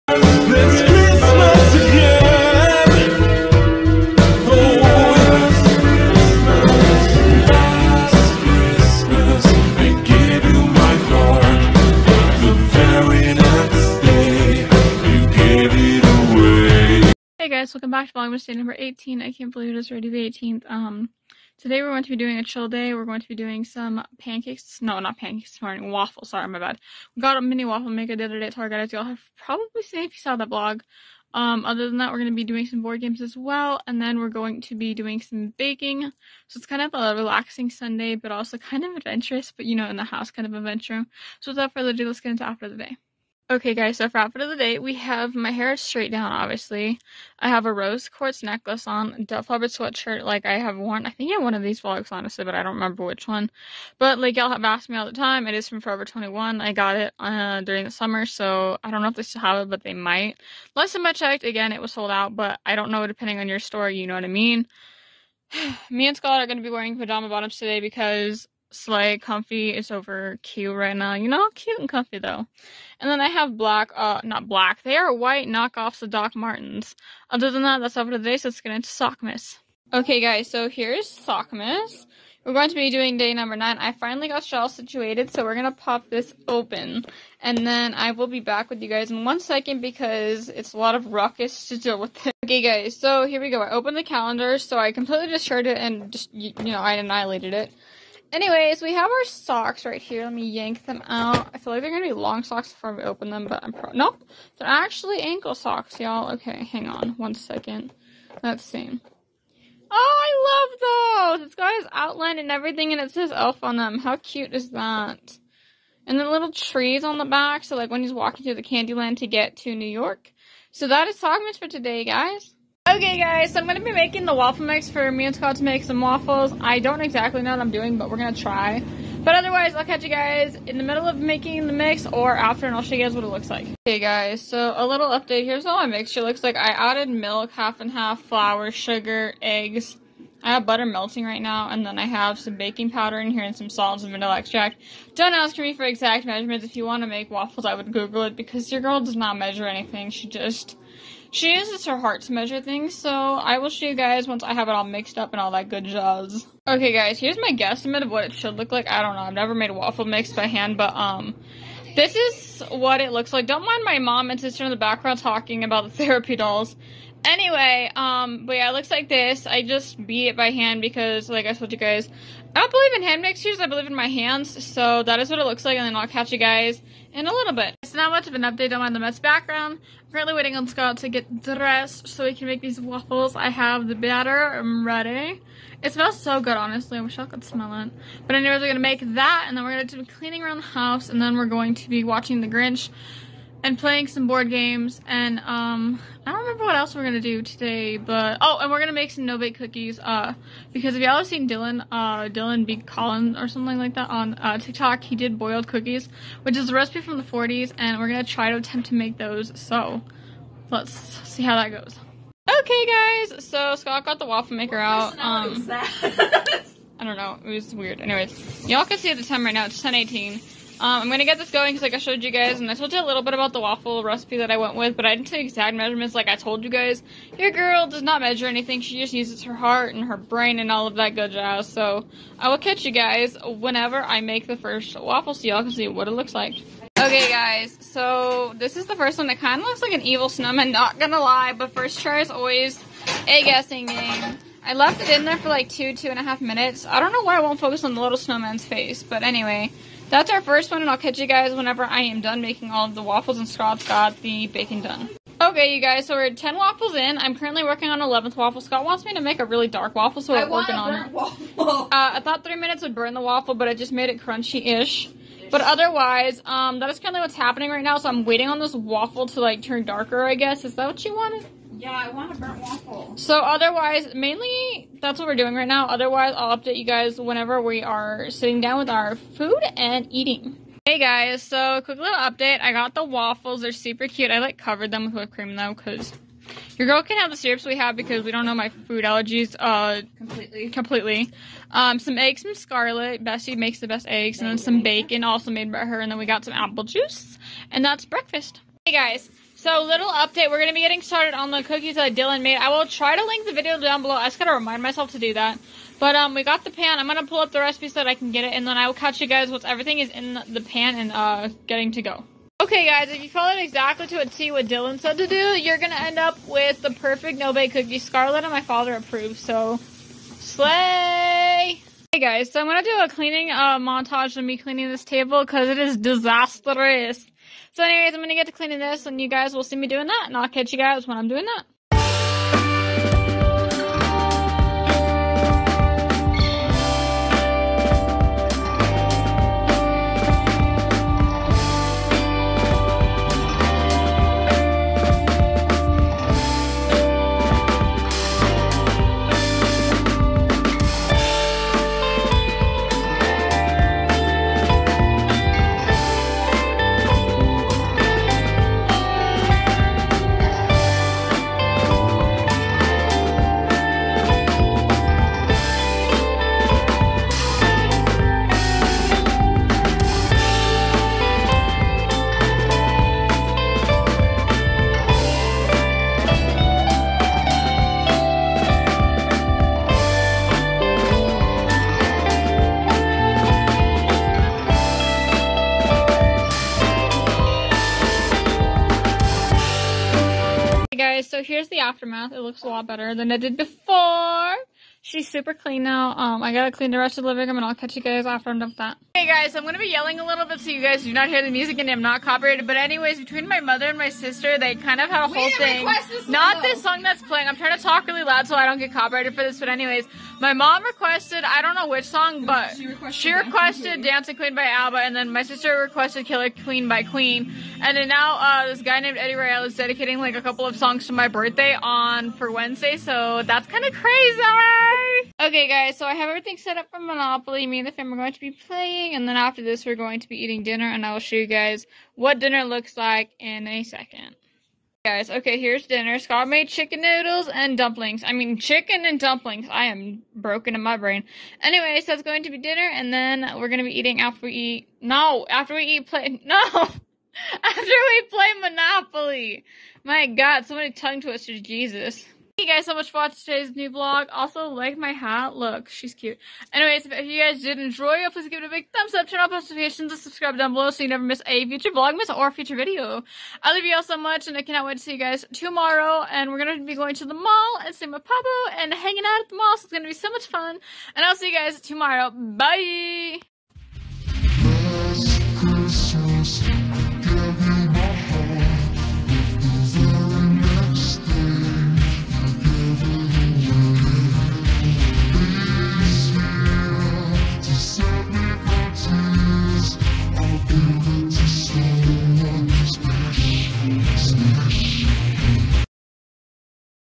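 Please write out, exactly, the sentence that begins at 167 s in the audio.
Anyway, um, but yeah, it looks like this.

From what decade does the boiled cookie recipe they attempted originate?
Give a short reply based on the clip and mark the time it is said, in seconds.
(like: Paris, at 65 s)
the 40s, at 207 s.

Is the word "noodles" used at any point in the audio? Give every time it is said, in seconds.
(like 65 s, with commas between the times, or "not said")
437 s.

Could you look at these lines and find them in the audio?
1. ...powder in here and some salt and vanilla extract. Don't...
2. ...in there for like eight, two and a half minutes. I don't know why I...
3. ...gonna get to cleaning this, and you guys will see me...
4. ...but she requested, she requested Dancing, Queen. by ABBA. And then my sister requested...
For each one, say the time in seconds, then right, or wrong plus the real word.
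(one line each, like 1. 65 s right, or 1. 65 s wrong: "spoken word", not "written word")
1. 142 s right
2. 245 s wrong: "two", not "eight"
3. 328 s right
4. 412 s right.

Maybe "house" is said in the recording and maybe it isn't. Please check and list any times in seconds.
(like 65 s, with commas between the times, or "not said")
40 s, 190 s.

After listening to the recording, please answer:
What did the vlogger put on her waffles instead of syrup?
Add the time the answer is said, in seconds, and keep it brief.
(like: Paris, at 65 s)
whipped cream, at 285 s.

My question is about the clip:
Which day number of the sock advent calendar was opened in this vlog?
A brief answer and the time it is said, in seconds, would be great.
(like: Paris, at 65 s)
9, at 83 s.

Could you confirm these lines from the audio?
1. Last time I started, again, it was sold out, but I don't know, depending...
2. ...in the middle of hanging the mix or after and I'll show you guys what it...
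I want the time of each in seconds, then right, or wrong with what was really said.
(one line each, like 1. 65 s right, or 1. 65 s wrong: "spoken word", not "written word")
1. 60 s wrong: "checked", not "started"
2. 130 s wrong: "making", not "hanging".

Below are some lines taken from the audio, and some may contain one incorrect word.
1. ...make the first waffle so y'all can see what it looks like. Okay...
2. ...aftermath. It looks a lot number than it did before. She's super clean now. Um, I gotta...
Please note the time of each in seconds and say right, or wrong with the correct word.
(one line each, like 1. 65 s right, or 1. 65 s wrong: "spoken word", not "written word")
1. 234 s right
2. 391 s wrong: "better", not "number".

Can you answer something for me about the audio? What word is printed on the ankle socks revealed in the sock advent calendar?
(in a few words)
elf.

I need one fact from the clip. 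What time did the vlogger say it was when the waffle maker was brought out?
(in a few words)
10:18.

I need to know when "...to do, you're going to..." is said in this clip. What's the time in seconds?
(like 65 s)
315 s.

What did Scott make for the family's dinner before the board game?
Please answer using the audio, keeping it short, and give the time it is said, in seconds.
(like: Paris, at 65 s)
chicken and dumplings, at 438 s.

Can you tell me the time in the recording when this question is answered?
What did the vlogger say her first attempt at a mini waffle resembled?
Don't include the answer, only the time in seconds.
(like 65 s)
240 s.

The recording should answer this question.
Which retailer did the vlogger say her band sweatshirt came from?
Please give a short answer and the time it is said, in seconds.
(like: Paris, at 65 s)
Forever 21, at 55 s.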